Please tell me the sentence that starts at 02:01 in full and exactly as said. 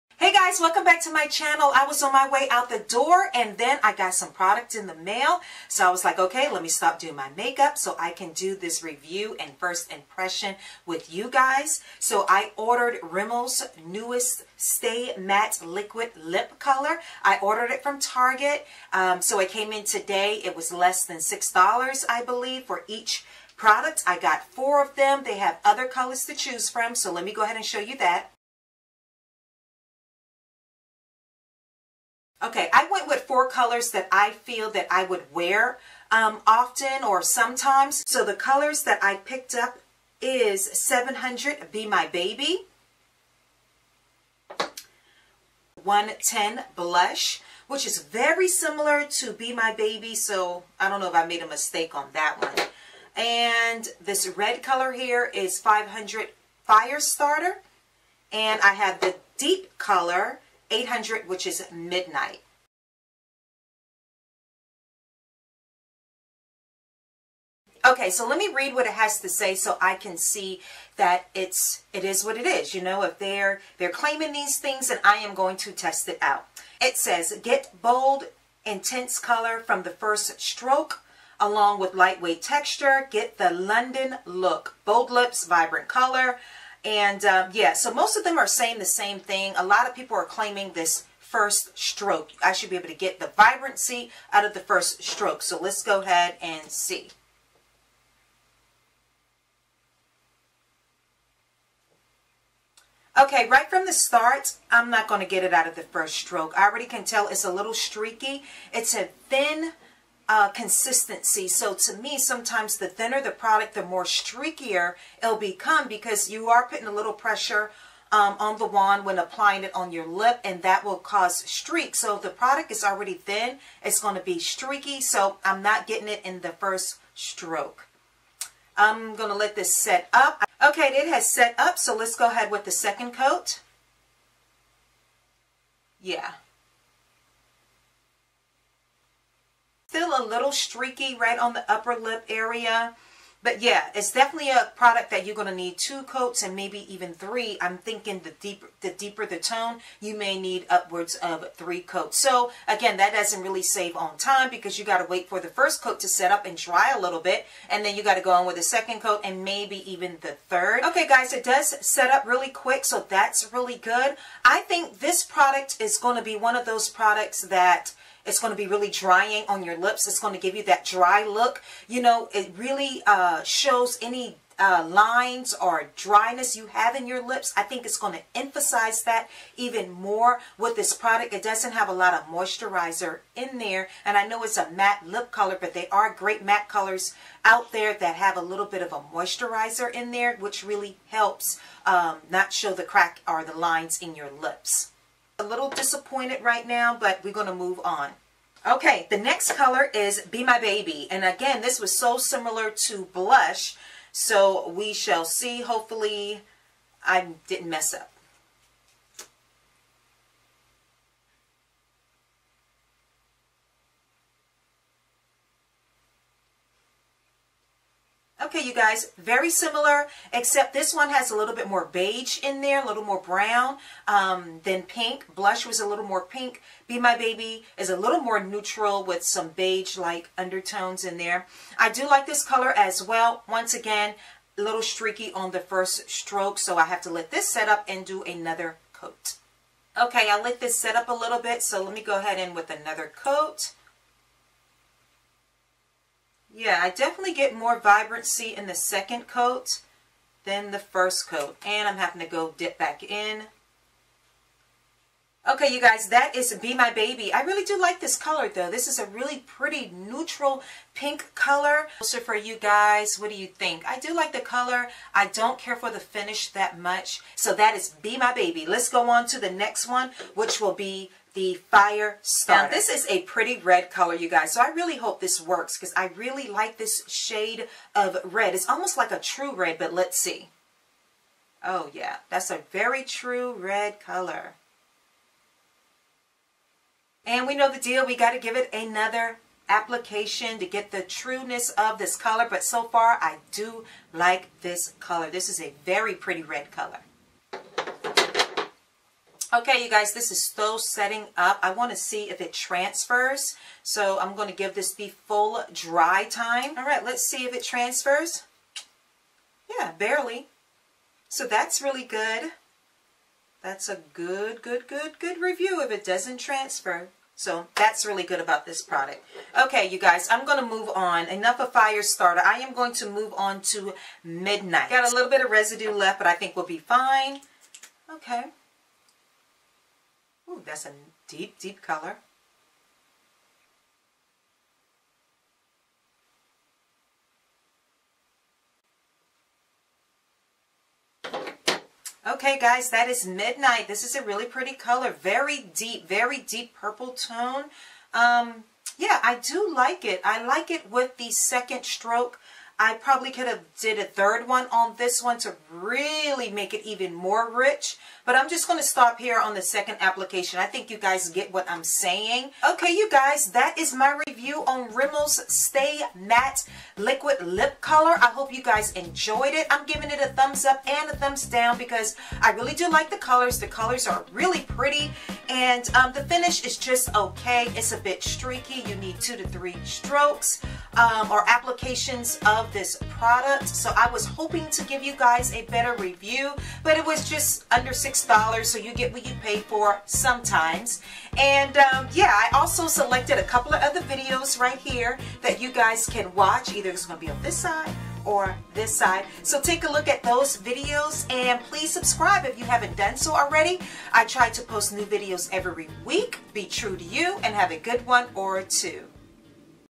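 So if the product is already thin, it's going to be streaky.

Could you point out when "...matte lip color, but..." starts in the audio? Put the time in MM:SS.
03:04.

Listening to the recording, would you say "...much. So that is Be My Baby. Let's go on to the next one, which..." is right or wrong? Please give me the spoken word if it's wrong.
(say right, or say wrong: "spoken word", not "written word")
right.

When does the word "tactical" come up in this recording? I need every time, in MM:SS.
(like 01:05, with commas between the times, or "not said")
not said.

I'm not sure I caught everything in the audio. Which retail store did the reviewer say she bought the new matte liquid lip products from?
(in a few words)
Target.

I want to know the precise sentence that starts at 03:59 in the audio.
Okay, I let this set up a little bit, so let me go ahead in with another coat.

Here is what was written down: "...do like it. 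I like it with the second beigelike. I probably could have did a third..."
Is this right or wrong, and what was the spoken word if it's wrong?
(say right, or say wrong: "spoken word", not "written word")
wrong: "stroke", not "beigelike".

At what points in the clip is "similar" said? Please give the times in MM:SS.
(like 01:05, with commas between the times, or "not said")
00:48, 03:22, 03:39.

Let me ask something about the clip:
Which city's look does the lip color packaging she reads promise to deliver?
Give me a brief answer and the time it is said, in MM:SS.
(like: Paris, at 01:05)
London, at 01:23.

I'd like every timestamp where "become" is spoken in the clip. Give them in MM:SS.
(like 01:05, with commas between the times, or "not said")
01:55.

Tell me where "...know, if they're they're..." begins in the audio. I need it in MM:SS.
01:12.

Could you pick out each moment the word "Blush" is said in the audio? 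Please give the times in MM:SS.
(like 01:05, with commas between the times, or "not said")
00:46, 03:23, 03:45.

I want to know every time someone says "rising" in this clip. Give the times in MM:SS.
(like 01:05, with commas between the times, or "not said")
not said.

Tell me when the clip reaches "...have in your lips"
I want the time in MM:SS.
02:56.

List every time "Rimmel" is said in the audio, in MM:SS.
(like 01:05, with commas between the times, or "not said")
00:13, 06:04.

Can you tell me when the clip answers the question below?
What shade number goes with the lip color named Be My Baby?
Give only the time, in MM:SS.
00:40.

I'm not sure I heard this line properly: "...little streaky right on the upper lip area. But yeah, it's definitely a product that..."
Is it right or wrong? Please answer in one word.
right.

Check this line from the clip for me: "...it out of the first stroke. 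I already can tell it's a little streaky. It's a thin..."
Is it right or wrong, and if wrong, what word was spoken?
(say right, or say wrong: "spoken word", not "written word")
right.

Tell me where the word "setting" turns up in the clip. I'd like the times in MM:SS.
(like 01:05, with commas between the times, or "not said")
05:00.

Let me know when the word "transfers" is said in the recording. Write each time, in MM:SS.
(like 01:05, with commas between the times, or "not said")
05:02, 05:07, 05:16.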